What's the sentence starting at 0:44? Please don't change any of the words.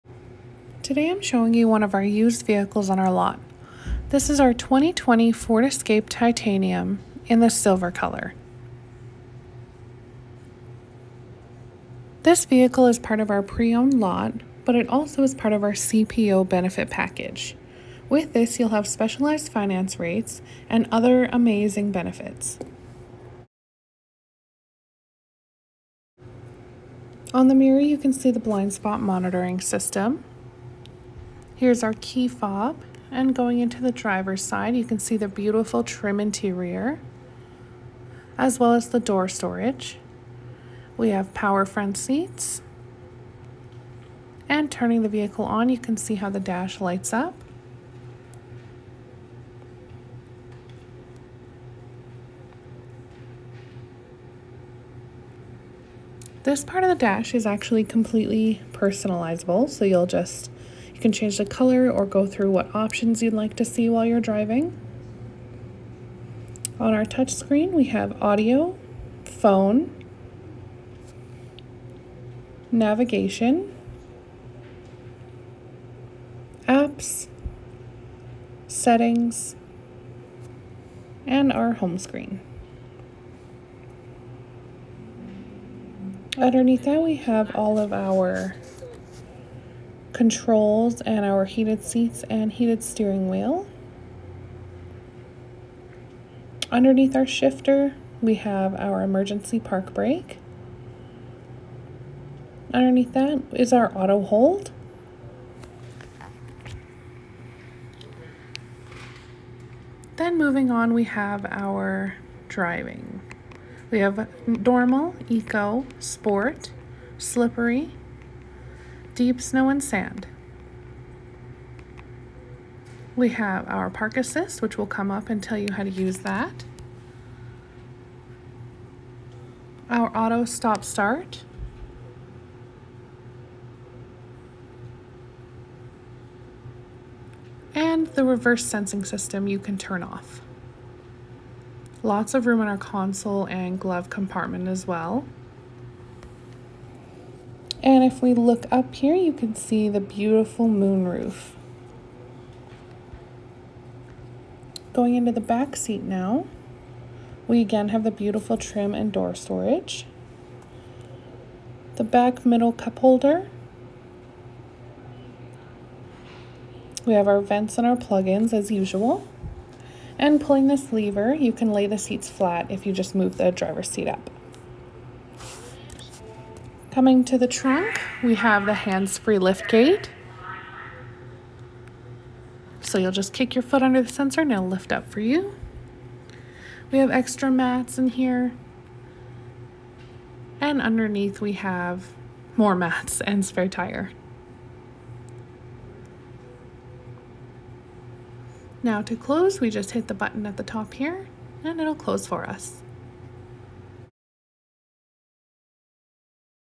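And turning the vehicle on, you can see how the dash lights up.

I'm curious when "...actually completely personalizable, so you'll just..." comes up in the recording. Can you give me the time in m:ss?
0:57.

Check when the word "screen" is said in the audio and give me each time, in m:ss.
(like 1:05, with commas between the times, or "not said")
1:07, 1:21.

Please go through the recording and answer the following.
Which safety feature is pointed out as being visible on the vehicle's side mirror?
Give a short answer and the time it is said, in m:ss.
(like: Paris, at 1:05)
Blind spot monitoring system, at 0:28.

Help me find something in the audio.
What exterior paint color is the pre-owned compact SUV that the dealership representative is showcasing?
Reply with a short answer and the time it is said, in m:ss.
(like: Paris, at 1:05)
Silver, at 0:07.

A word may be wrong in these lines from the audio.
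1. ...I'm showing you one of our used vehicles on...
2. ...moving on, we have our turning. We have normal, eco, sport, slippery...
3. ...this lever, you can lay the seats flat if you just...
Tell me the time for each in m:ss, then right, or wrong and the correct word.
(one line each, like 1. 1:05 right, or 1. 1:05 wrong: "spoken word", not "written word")
1. 0:01 right
2. 1:50 wrong: "driving", not "turning"
3. 2:50 right.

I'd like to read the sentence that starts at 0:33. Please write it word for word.
And going into the driver's side, you can see the beautiful trim interior, as well as the door storage.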